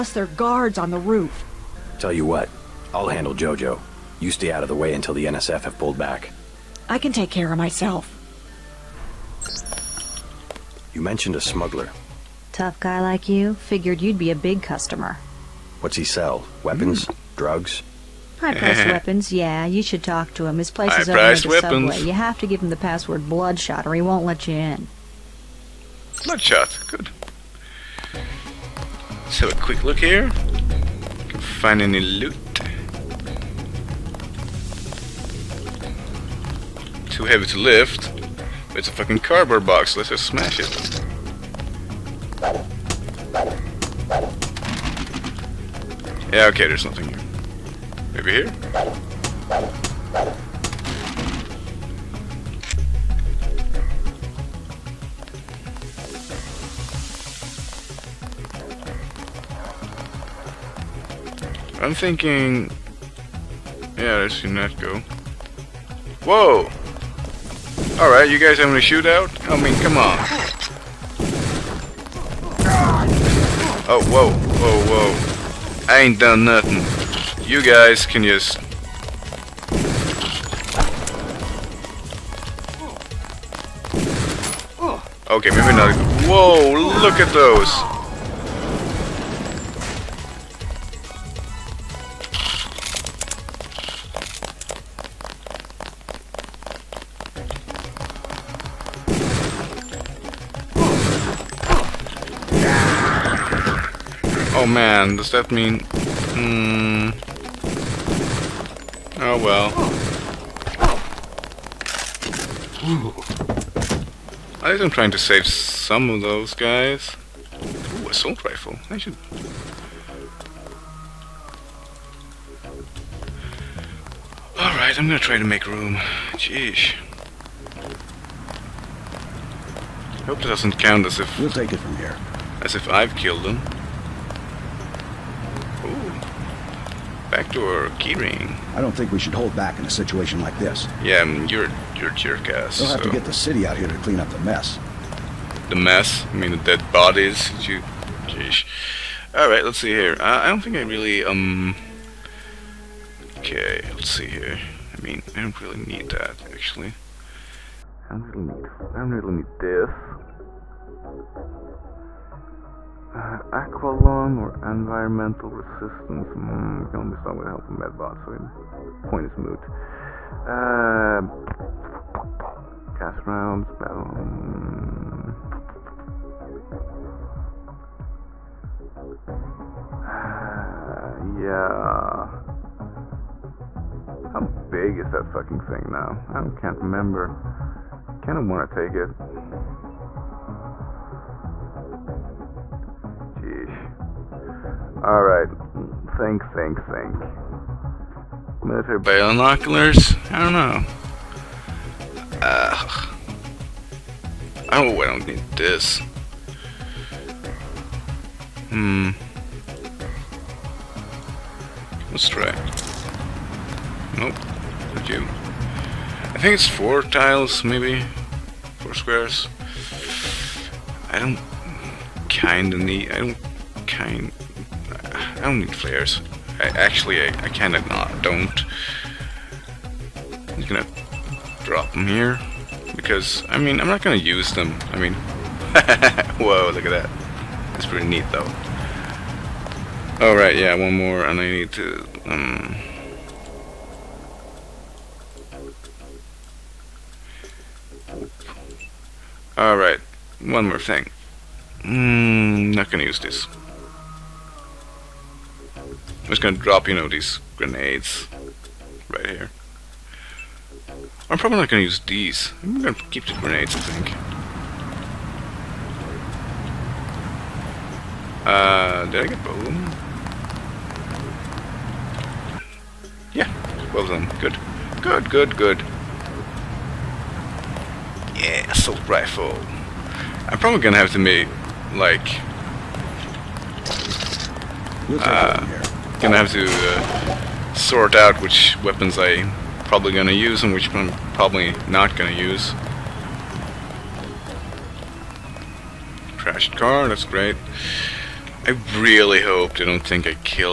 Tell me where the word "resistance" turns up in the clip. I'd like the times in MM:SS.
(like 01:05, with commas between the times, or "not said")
02:45.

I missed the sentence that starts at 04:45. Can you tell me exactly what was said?
Uh, gonna have to uh, sort out which weapons I probably gonna use and which I'm probably not gonna use.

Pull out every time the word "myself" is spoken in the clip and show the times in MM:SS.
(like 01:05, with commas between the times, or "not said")
00:07.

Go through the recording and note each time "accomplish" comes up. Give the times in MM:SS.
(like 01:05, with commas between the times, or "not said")
not said.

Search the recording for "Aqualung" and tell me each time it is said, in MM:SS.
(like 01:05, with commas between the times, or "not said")
02:43.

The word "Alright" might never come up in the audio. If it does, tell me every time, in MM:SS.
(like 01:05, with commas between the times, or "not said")
01:08, 02:04, 03:15, 04:00, 04:09.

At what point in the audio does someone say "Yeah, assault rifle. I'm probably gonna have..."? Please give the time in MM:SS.
04:38.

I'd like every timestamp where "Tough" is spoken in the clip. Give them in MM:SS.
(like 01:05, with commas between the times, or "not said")
00:12.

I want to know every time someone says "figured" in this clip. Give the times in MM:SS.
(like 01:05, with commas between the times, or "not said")
00:13.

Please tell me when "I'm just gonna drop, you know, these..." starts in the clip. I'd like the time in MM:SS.
04:16.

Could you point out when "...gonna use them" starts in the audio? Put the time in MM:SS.
03:54.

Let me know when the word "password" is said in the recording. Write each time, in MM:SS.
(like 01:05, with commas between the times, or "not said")
00:22.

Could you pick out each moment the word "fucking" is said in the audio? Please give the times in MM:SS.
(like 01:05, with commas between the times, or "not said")
00:38, 03:05.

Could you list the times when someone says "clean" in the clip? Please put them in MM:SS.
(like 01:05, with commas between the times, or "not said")
02:24.